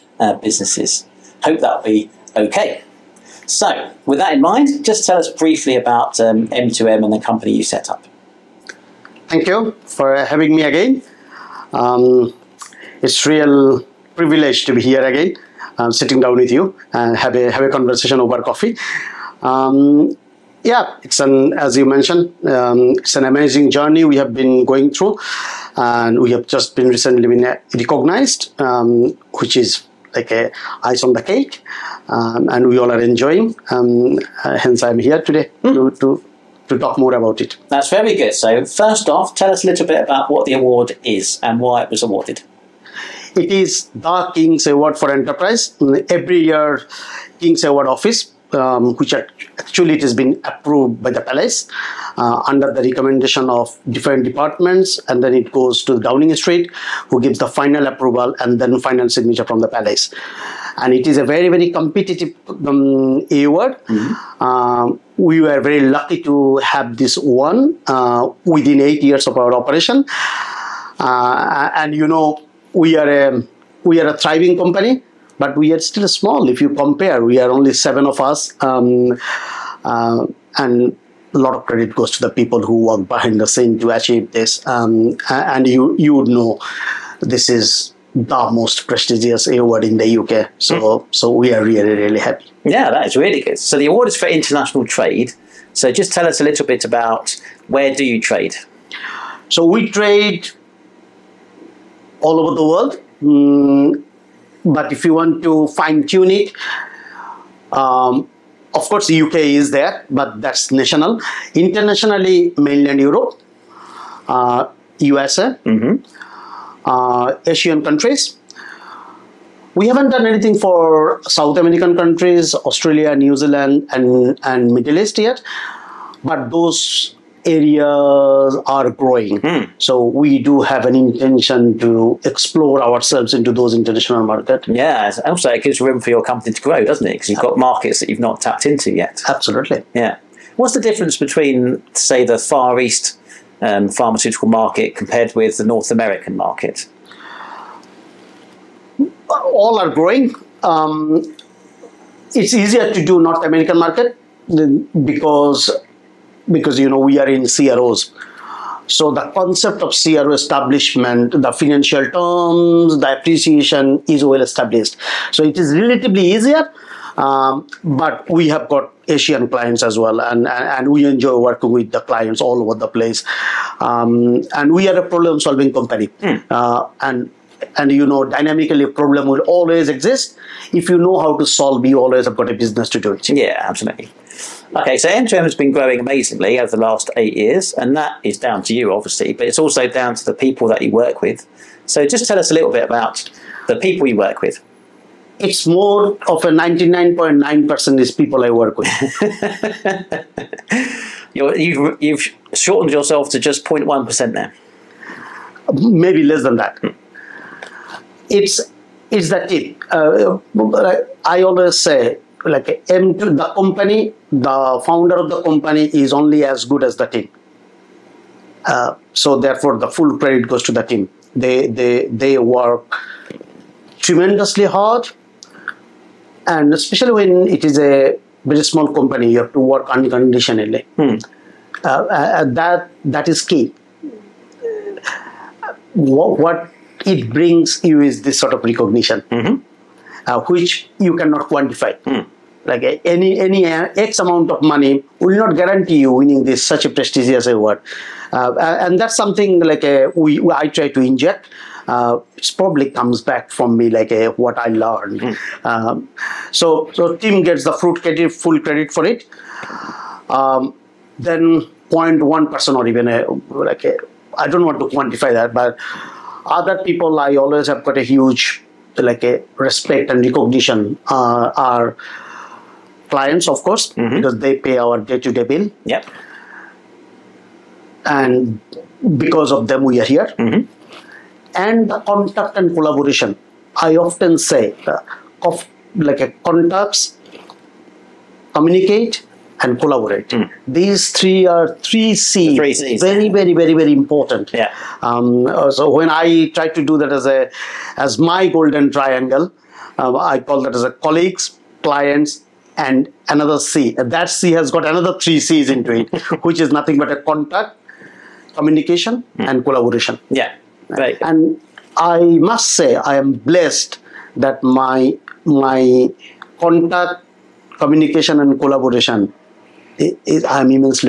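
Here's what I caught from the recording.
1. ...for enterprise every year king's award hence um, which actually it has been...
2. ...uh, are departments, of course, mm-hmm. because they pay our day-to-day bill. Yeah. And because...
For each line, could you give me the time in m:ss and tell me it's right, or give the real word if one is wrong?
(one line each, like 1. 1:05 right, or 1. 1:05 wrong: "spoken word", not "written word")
1. 0:44 wrong: "office", not "hence"
2. 4:31 wrong: "clients", not "departments".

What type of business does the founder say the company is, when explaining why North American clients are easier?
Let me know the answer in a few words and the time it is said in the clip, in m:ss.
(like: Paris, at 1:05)
CROs, at 2:37.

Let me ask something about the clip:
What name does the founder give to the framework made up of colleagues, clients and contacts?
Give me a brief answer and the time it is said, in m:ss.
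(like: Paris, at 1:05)
golden triangle, at 4:58.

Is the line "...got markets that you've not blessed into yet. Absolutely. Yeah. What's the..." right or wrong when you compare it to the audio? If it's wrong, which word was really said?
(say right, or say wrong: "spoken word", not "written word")
wrong: "tapped", not "blessed".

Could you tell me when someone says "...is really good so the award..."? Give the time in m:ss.
1:33.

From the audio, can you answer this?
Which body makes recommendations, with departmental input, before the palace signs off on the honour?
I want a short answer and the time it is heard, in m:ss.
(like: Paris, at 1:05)
Downing Street, at 0:55.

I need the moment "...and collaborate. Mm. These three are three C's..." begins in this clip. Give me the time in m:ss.
4:49.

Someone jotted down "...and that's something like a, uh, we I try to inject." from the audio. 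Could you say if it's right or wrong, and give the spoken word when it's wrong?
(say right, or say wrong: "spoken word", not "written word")
right.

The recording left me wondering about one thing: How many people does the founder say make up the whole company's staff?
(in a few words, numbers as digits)
7.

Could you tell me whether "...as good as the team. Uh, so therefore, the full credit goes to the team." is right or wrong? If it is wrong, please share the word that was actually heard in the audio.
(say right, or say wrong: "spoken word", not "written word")
right.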